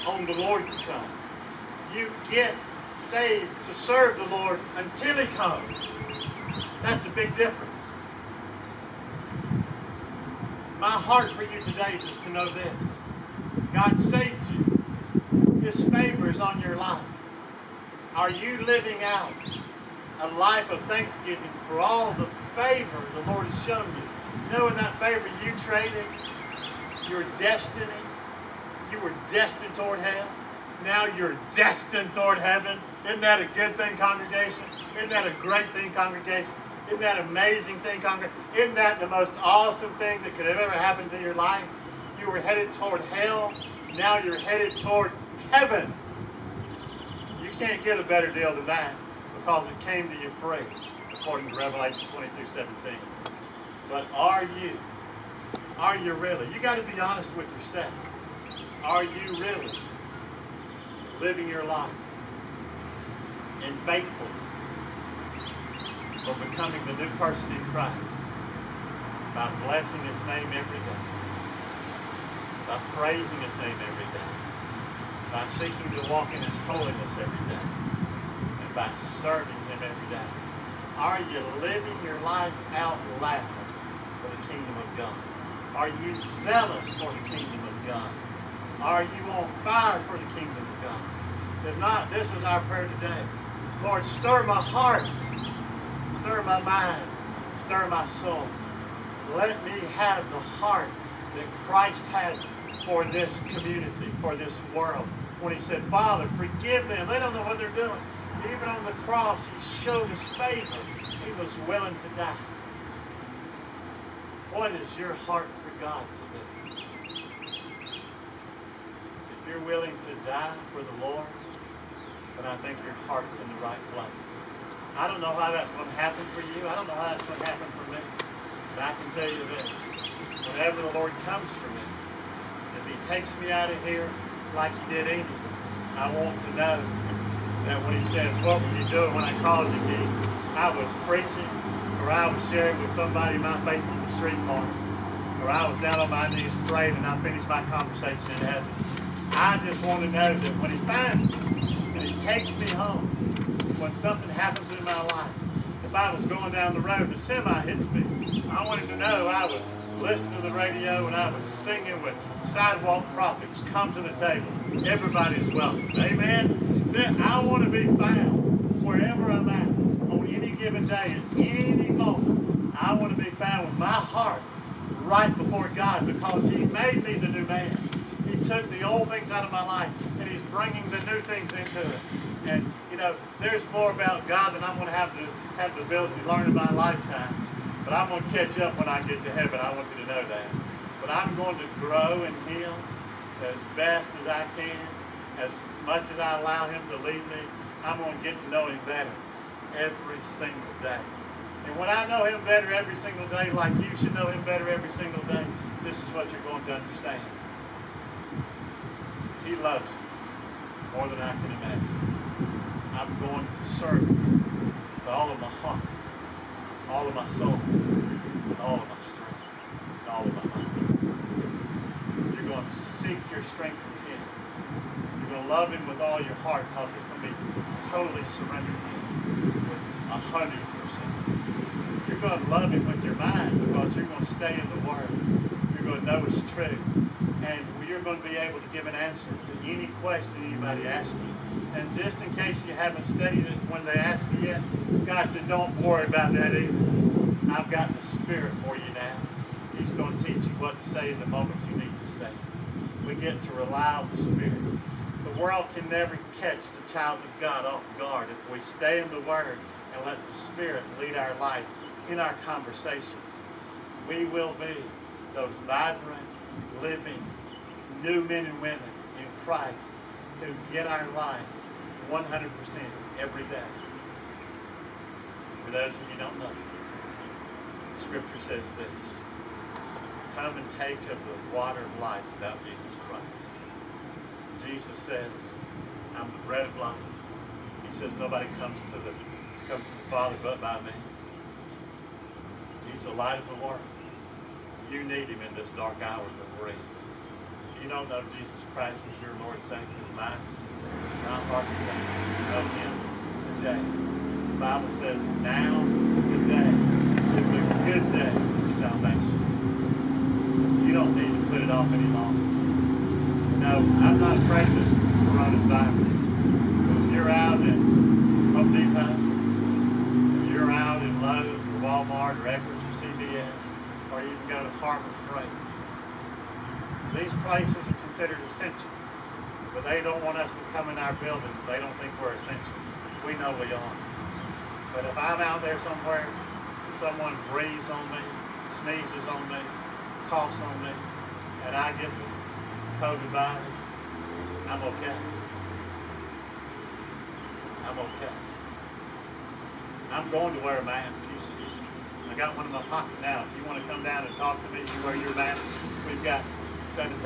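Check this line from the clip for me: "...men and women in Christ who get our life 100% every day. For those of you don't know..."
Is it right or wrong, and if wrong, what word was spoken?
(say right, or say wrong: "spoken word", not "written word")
right.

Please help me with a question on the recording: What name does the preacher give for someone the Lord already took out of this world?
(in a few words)
Amy.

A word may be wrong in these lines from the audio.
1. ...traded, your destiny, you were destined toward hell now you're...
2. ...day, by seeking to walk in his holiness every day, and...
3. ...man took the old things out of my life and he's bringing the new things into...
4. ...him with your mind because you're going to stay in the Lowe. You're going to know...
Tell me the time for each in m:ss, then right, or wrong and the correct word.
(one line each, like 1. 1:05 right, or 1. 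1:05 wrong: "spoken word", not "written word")
1. 0:25 right
2. 1:14 right
3. 2:57 right
4. 3:52 wrong: "Word", not "Lowe".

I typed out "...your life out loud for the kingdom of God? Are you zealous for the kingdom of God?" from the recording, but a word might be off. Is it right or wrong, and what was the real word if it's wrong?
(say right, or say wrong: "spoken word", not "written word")
right.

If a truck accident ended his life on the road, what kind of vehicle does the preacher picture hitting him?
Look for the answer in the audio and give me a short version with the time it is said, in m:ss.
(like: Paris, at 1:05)
semi, at 2:37.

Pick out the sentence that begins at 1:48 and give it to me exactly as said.
Even on the cross, he showed his favor.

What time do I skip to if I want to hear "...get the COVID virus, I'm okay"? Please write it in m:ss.
5:42.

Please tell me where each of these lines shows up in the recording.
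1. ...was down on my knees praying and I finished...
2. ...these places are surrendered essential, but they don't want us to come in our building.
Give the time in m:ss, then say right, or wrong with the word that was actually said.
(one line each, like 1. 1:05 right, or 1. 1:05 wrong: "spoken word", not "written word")
1. 2:25 right
2. 5:27 wrong: "considered", not "surrendered".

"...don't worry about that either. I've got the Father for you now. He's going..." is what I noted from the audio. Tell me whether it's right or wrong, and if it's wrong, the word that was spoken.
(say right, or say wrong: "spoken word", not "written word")
wrong: "Spirit", not "Father".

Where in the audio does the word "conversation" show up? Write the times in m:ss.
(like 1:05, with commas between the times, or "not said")
2:27, 4:22.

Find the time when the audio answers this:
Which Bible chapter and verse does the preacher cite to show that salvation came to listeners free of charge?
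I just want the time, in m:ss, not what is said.
0:51.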